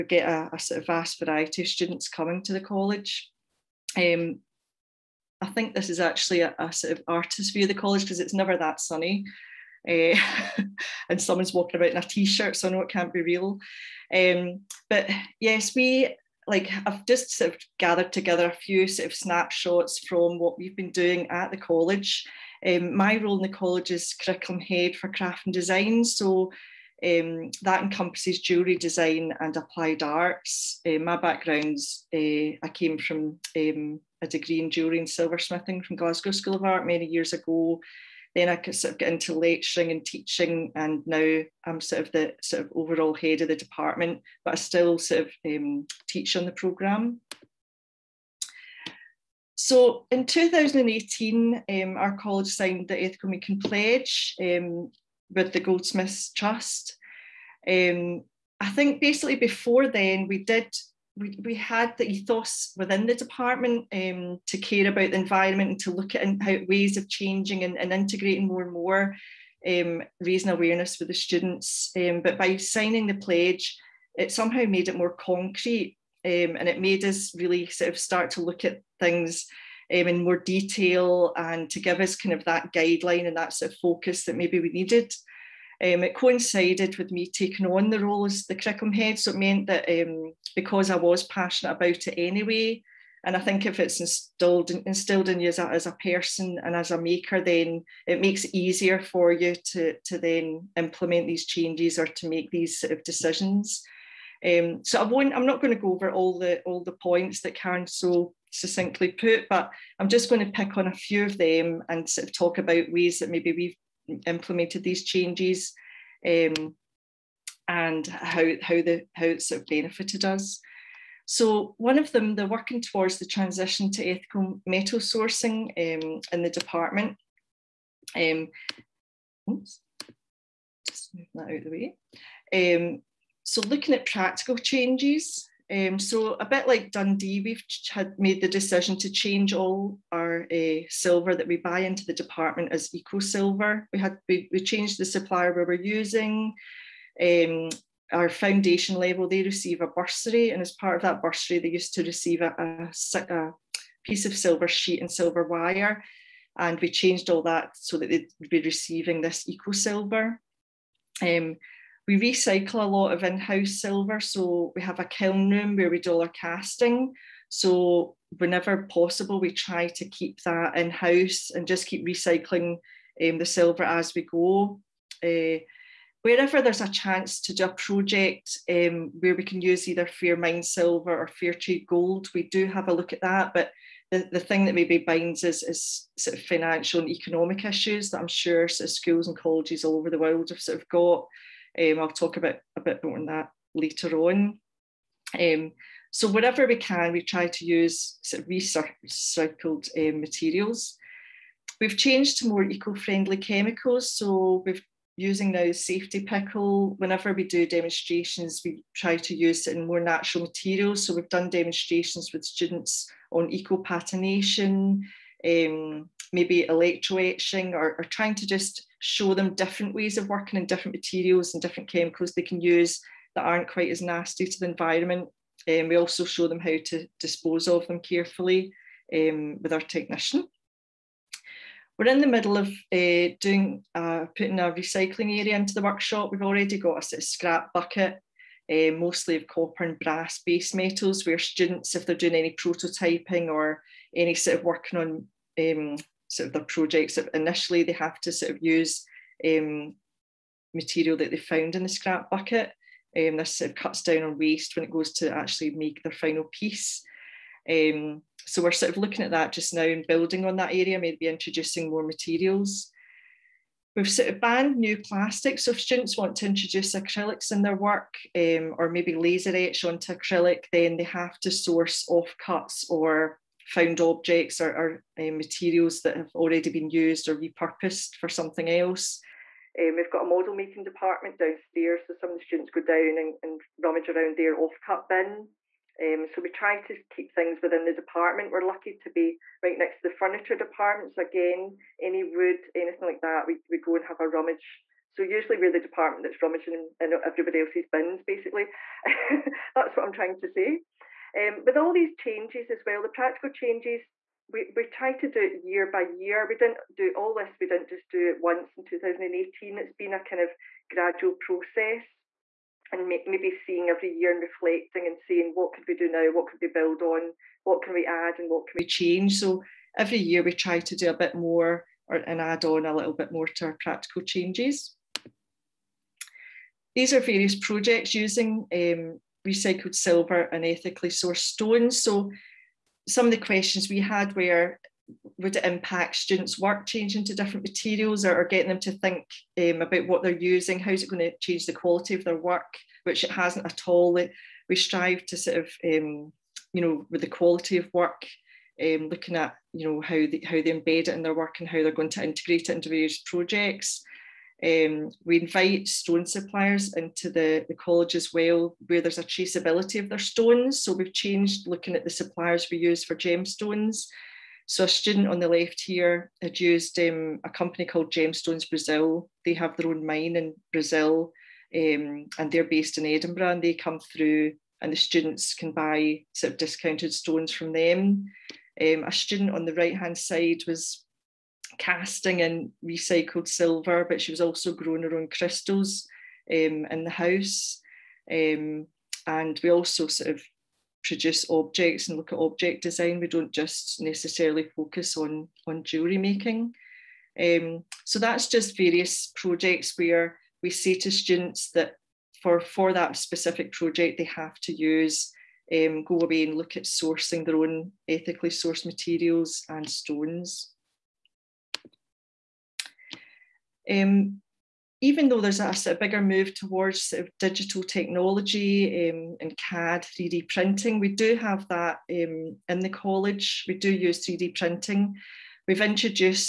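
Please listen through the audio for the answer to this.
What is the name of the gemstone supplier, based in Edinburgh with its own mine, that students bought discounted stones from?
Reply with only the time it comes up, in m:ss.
6:08.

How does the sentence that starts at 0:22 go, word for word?
Um, my role in the college is curriculum head for craft and design, so um, that encompasses jewellery design and applied arts.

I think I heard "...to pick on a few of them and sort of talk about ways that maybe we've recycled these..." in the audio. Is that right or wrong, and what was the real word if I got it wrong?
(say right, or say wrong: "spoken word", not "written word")
wrong: "implemented", not "recycled".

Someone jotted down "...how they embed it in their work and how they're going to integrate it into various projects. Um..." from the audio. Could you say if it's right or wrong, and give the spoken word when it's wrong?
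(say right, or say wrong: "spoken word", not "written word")
right.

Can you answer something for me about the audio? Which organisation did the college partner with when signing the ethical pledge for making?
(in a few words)
Goldsmiths Trust.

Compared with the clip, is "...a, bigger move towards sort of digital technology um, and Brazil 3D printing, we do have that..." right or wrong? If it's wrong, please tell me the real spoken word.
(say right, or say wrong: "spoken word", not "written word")
wrong: "CAD", not "Brazil".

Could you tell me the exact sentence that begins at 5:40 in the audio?
How's it going to change the quality of their work, which it hasn't at all?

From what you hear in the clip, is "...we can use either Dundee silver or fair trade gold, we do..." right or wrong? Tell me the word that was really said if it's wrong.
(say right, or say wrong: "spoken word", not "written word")
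wrong: "Fairmined", not "Dundee".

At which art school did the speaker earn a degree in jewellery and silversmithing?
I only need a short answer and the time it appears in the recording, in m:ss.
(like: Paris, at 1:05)
Glasgow School of Art, at 0:35.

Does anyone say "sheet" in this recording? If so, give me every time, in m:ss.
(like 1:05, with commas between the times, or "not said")
2:34.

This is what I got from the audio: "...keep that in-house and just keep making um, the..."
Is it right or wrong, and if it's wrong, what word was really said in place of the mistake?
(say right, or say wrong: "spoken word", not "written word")
wrong: "recycling", not "making".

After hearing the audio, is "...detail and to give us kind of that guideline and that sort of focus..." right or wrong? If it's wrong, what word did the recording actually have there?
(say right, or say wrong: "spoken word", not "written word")
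right.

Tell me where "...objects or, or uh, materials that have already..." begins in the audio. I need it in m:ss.
4:34.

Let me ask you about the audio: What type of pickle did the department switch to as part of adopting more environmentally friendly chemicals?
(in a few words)
Safety pickle.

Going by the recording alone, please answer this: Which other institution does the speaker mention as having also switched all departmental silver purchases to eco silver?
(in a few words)
Dundee.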